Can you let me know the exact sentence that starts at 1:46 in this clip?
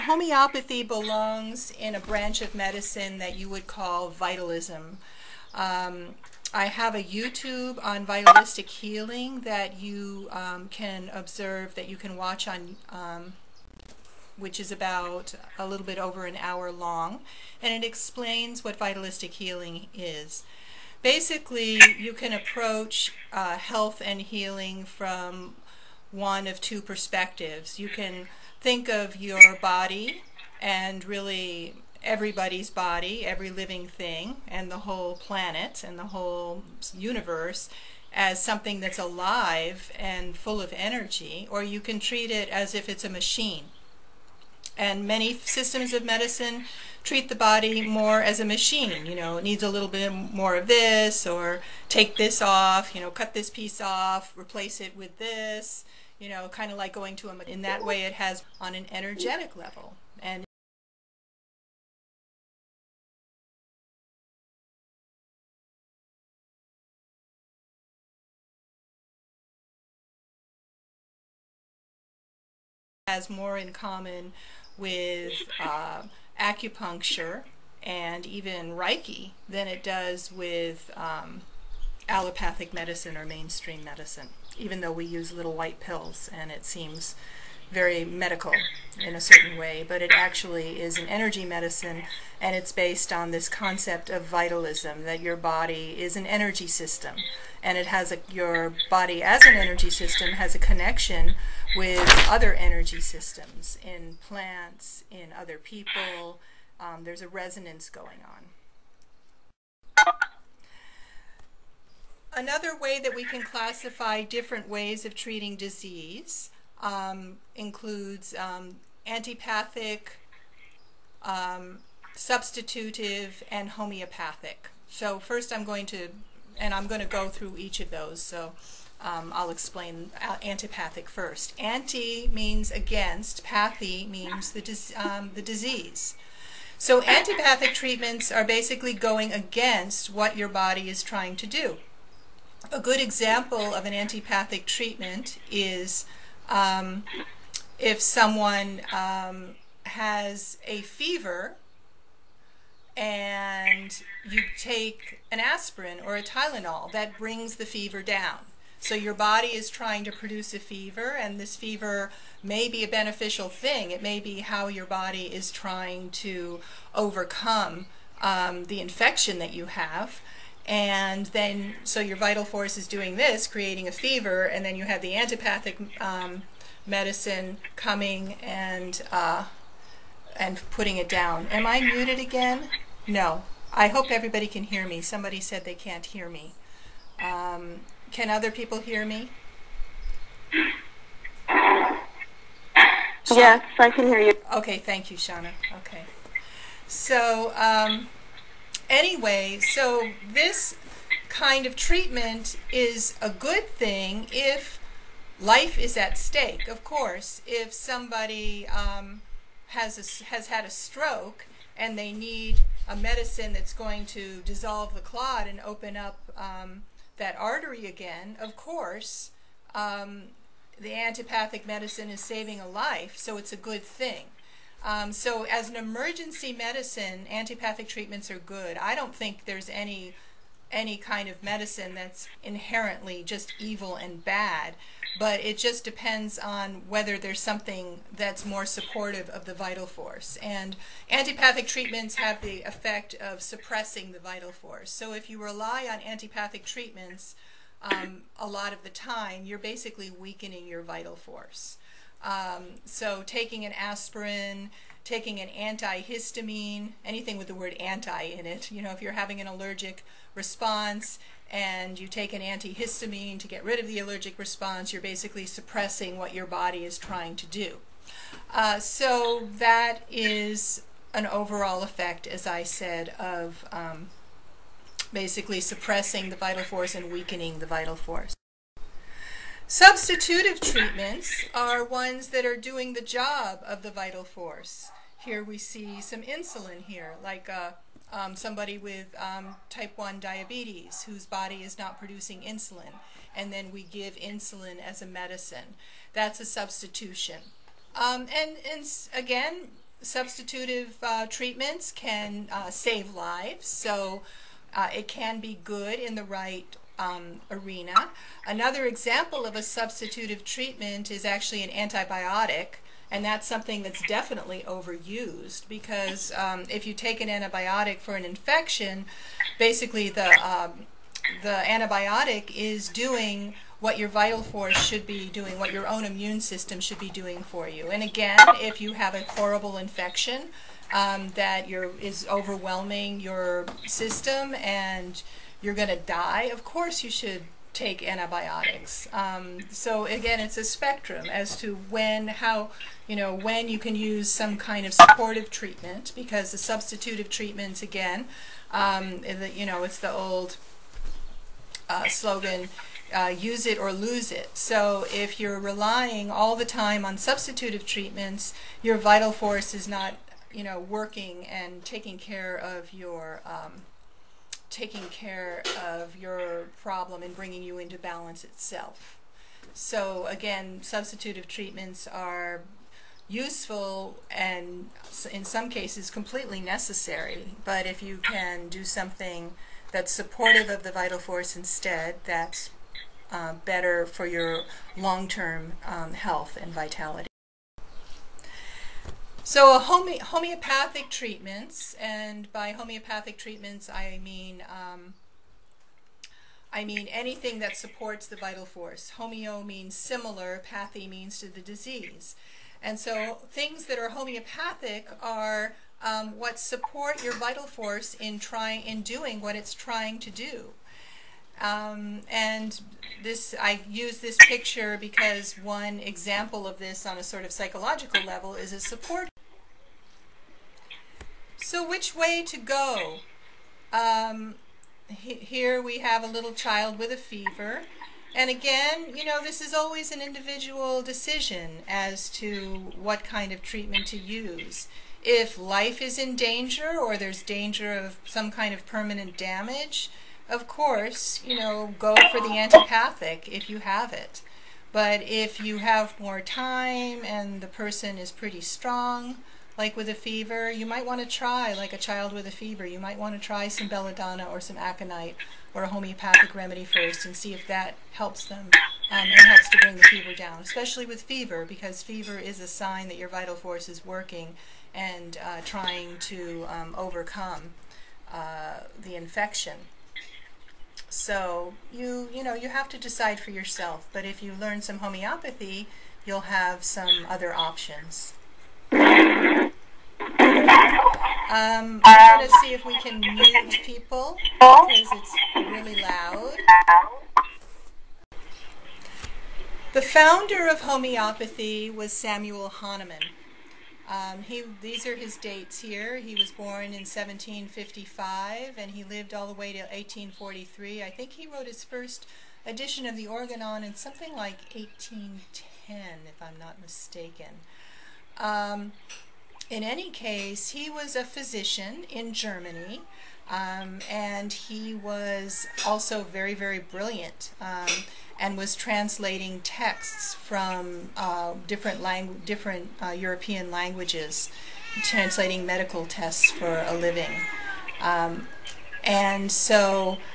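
Um, there's a resonance going on.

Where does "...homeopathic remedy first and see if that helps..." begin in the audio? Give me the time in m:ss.
7:35.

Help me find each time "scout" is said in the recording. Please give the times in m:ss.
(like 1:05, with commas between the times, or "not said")
not said.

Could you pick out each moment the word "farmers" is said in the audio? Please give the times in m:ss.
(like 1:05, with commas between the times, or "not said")
not said.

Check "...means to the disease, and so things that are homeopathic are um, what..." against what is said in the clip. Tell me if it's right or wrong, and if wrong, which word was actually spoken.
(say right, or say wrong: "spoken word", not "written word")
right.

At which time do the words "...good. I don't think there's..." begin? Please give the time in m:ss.
3:48.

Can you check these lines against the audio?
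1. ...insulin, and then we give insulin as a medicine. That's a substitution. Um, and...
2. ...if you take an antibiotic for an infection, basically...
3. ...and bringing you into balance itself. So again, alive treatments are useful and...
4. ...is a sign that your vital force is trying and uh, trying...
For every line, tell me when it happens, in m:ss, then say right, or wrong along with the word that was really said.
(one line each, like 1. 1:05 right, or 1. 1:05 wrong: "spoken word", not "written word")
1. 4:52 right
2. 5:16 right
3. 6:07 wrong: "substitutive", not "alive"
4. 7:42 wrong: "working", not "trying".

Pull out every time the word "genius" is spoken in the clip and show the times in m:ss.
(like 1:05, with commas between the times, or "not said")
not said.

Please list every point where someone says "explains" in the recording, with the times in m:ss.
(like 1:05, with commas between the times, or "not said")
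0:17, 2:09.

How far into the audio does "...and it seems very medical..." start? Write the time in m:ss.
1:26.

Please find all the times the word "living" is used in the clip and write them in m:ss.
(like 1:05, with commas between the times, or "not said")
0:33, 8:46.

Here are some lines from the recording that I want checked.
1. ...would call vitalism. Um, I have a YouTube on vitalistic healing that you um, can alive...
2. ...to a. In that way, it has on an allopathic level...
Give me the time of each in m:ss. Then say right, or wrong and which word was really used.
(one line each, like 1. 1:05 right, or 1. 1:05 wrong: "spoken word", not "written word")
1. 0:03 wrong: "observe", not "alive"
2. 0:57 wrong: "energetic", not "allopathic".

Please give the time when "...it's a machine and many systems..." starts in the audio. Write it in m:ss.
0:42.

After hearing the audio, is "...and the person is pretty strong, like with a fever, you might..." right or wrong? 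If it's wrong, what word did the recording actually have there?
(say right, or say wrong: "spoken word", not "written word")
right.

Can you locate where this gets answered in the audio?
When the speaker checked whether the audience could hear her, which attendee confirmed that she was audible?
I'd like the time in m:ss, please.
3:15.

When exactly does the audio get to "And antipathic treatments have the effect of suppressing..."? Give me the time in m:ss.
4:00.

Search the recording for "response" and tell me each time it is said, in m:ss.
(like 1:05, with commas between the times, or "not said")
4:20, 4:24.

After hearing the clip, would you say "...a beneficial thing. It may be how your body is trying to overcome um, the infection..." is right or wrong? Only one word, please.
right.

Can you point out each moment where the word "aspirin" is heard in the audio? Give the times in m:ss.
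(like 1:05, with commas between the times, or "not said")
2:35, 4:13.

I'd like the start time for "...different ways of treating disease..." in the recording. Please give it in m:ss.
1:54.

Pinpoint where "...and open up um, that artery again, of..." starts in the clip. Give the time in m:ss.
3:35.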